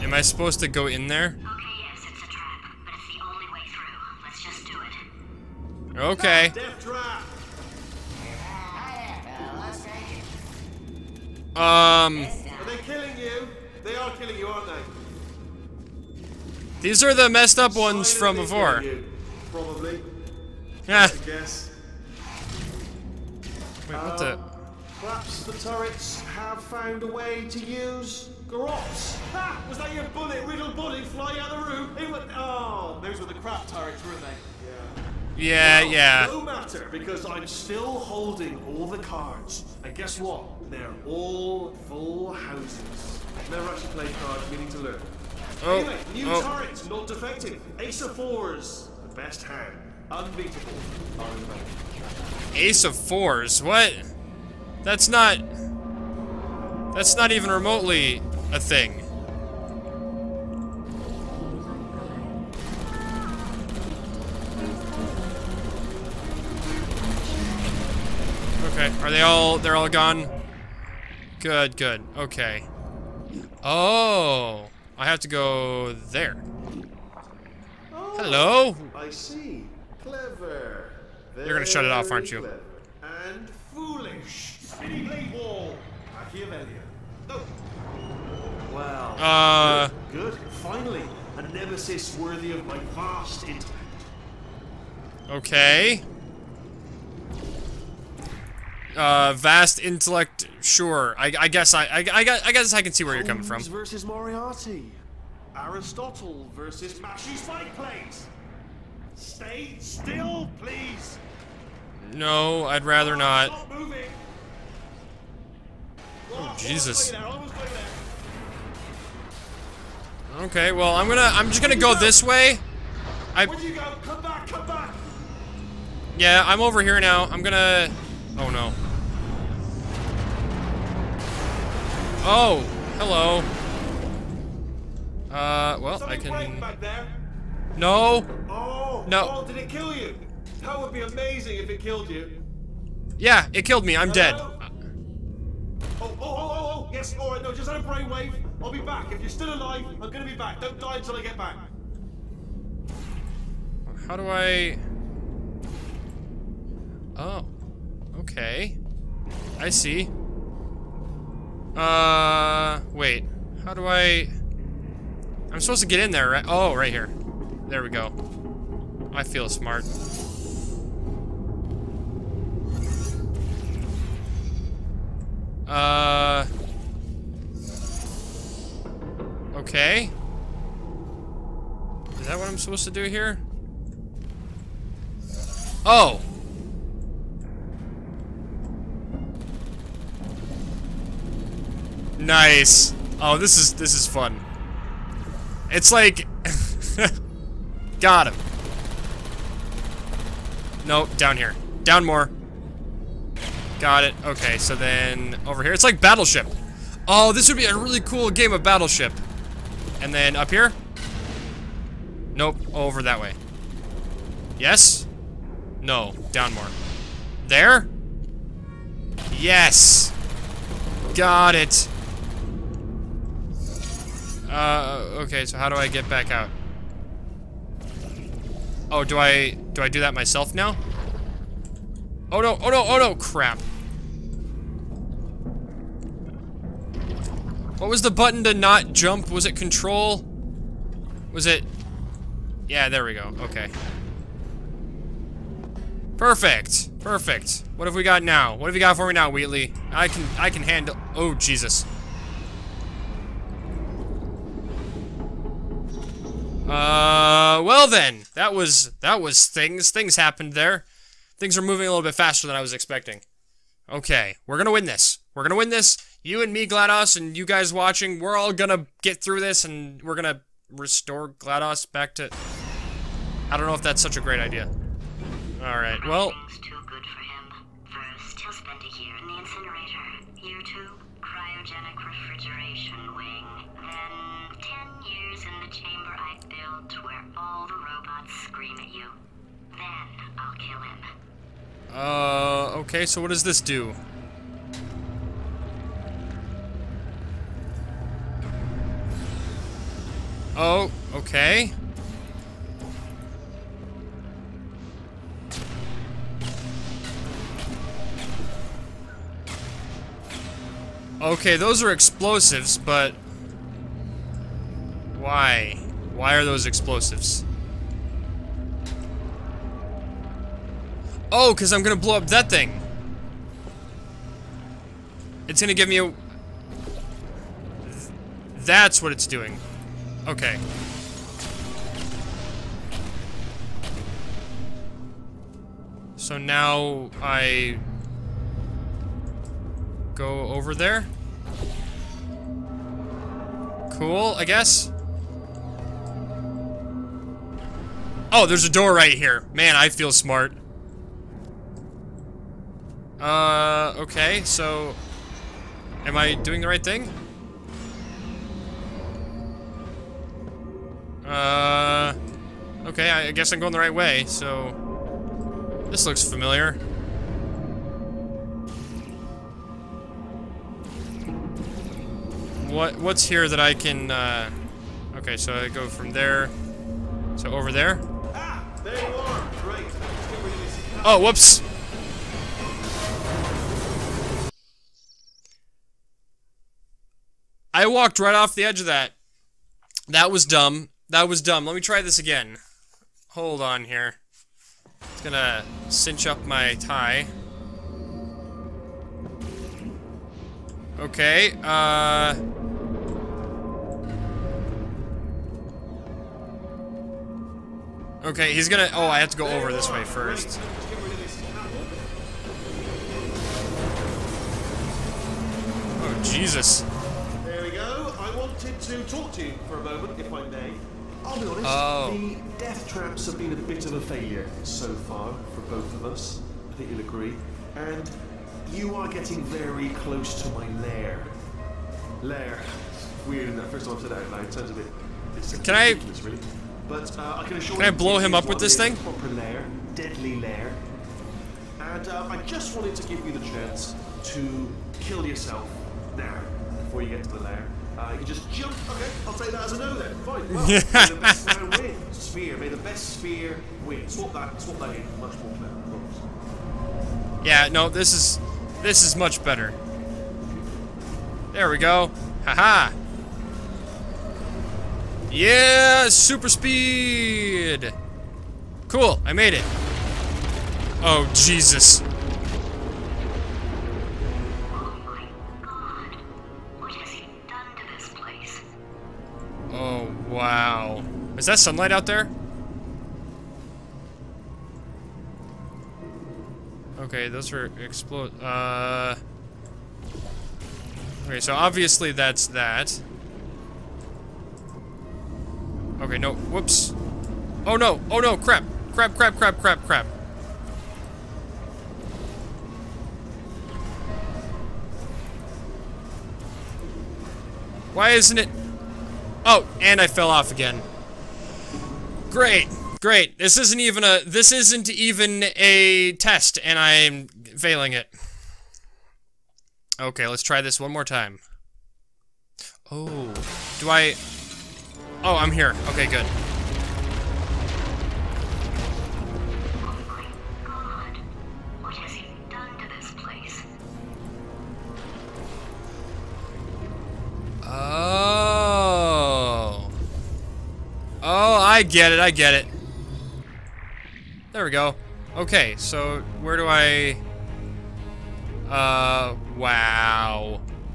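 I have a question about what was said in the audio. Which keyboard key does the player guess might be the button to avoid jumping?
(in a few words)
Control.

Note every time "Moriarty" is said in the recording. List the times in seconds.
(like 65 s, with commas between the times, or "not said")
104 s.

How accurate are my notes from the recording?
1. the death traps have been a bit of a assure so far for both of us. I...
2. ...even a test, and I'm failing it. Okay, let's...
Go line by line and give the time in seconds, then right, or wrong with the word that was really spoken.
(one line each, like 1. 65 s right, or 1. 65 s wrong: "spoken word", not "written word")
1. 422 s wrong: "failure", not "assure"
2. 514 s right.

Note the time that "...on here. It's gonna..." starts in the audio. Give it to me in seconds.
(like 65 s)
393 s.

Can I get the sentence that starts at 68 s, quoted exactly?
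Okay, are they all, they're all gone?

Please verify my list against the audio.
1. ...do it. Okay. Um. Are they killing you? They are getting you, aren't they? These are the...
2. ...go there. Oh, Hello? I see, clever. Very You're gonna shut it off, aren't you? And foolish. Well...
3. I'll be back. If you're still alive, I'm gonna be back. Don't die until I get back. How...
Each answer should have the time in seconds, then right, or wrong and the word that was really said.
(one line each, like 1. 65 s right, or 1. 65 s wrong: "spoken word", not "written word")
1. 4 s wrong: "killing", not "getting"
2. 75 s right
3. 148 s right.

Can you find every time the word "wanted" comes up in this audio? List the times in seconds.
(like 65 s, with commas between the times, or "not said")
418 s, 442 s.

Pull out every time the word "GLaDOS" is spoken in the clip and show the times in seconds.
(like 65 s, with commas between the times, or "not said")
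266 s, 271 s.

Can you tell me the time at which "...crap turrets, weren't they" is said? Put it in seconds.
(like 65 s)
33 s.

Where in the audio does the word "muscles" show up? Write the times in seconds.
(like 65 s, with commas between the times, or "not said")
not said.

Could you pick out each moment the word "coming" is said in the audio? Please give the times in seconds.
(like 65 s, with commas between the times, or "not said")
103 s.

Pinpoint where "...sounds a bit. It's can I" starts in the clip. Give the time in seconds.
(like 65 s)
434 s.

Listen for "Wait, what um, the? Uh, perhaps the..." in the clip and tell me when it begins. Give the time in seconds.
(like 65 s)
23 s.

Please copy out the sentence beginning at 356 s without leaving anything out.
Am I doing the right thing?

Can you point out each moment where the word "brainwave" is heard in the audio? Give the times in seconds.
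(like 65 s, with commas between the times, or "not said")
147 s.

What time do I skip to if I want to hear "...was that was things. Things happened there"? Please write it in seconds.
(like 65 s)
258 s.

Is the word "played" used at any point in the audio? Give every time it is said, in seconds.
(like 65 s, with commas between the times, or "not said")
43 s.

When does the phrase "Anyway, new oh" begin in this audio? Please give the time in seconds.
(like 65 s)
45 s.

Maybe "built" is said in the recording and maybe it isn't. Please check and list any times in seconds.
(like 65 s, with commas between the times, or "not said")
286 s.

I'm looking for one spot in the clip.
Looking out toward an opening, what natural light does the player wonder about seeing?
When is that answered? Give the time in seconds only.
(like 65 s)
481 s.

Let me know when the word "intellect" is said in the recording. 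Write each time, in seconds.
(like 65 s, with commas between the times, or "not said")
93 s, 99 s.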